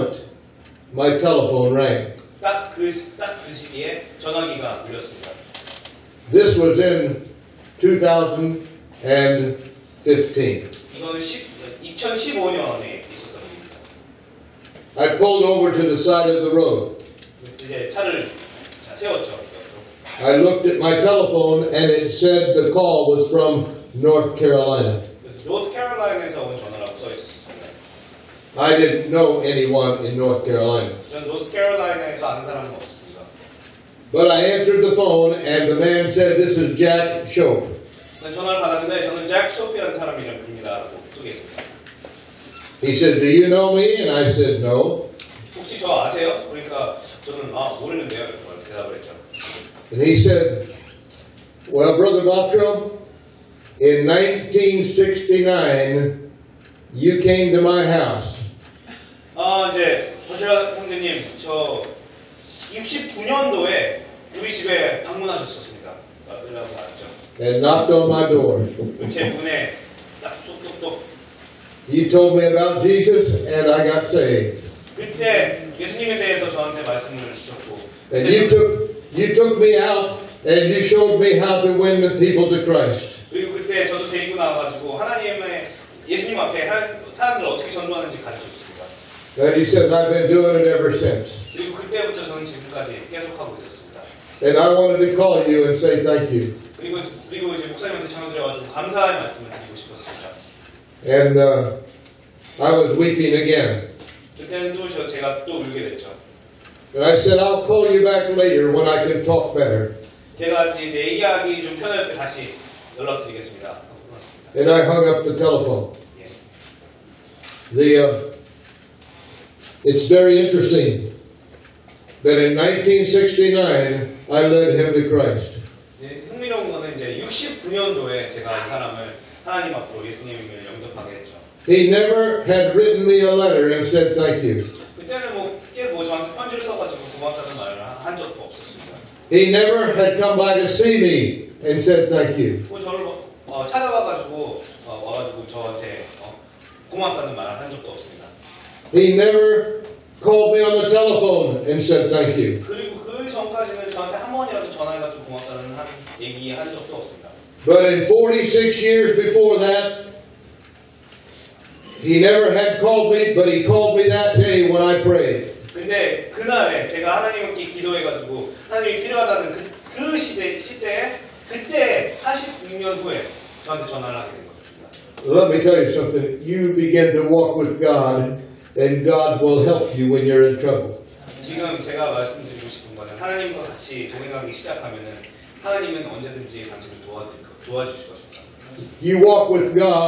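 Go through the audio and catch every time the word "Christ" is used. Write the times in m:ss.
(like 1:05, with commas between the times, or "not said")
1:22, 2:05.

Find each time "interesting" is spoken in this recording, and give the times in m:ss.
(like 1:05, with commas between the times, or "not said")
2:00.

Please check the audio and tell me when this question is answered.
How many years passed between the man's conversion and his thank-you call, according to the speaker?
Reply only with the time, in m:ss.
2:38.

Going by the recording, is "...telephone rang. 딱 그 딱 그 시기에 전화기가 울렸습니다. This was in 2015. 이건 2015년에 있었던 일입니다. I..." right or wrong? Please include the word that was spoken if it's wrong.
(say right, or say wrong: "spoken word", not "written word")
right.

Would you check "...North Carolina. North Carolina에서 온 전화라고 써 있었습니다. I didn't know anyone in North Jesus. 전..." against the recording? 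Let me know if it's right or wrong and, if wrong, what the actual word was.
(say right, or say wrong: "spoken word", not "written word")
wrong: "Carolina", not "Jesus".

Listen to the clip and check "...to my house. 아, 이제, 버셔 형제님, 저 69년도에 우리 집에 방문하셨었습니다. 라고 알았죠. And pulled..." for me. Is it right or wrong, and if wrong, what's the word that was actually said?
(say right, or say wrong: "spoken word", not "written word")
wrong: "knocked", not "pulled".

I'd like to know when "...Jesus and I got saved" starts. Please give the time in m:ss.
1:12.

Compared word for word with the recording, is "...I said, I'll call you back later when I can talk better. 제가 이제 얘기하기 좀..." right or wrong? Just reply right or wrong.
right.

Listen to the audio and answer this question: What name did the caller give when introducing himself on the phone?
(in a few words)
Jack Shope.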